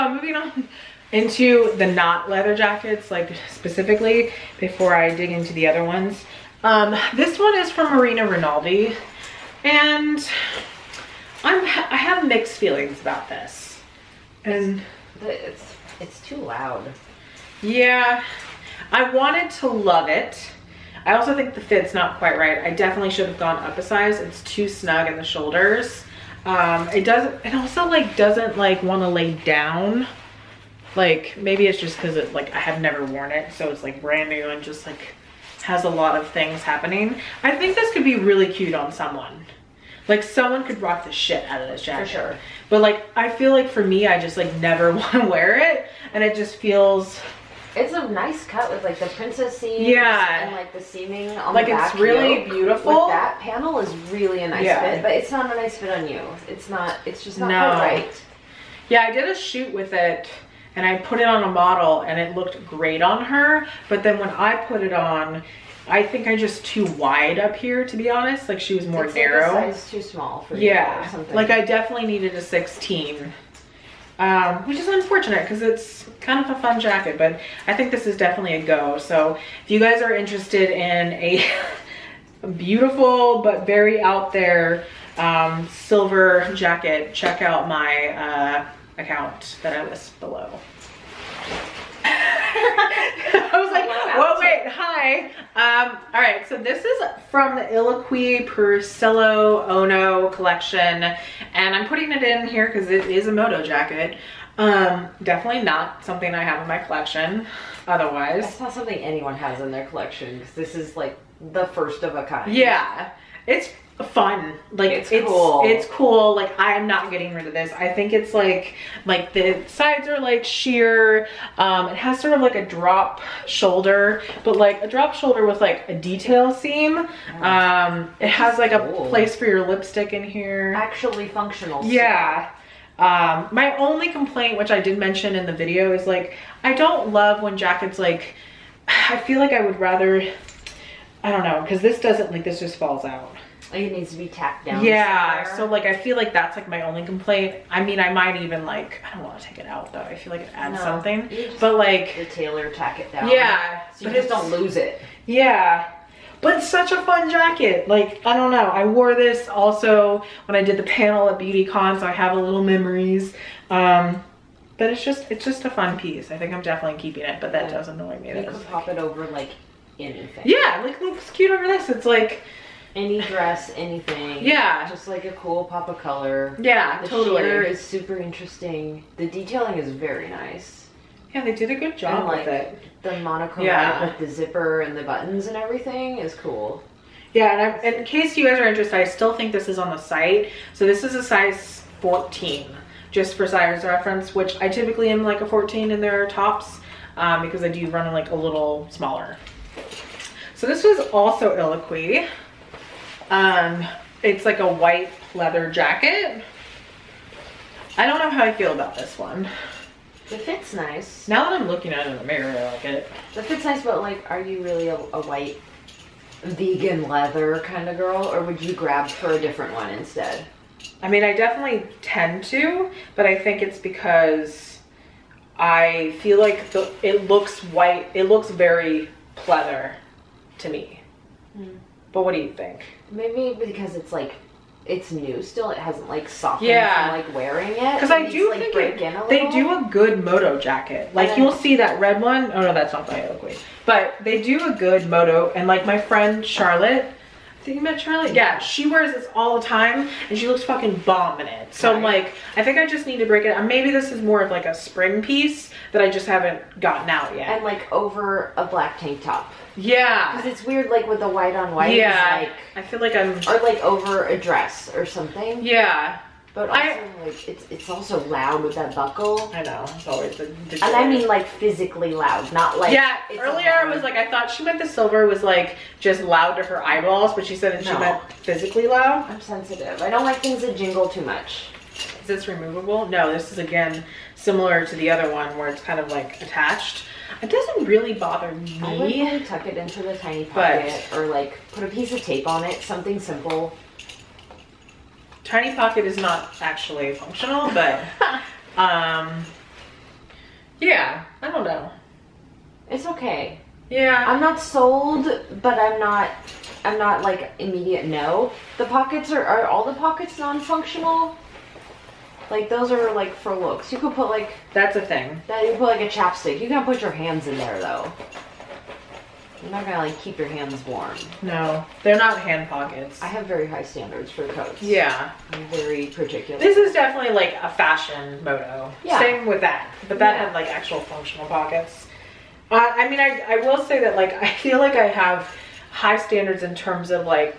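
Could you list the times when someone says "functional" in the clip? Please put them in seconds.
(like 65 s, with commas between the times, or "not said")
131 s, 297 s, 310 s, 331 s.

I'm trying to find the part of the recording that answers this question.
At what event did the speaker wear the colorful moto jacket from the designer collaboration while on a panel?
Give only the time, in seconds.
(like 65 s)
161 s.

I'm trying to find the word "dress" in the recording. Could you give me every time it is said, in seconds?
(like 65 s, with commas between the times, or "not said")
173 s, 264 s.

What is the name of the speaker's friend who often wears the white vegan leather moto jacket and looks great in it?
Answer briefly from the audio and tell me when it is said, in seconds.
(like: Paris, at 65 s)
Charlotte, at 246 s.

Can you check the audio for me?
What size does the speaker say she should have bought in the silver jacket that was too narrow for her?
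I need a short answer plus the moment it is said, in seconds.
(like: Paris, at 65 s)
16, at 72 s.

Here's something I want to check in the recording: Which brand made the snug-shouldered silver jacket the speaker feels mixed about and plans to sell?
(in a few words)
Marina Rinaldi.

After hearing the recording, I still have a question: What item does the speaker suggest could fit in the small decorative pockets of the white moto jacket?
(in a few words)
chapstick.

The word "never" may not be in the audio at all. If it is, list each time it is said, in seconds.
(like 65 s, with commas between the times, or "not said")
32 s, 44 s.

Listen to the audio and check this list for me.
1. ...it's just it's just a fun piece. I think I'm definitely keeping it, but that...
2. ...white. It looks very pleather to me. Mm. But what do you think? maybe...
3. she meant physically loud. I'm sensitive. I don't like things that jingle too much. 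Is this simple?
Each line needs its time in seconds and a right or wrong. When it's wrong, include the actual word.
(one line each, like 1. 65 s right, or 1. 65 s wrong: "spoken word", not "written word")
1. 164 s right
2. 227 s right
3. 277 s wrong: "removable", not "simple".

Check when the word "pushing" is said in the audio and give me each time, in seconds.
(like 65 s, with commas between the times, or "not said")
not said.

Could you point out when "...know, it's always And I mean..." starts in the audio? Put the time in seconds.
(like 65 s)
269 s.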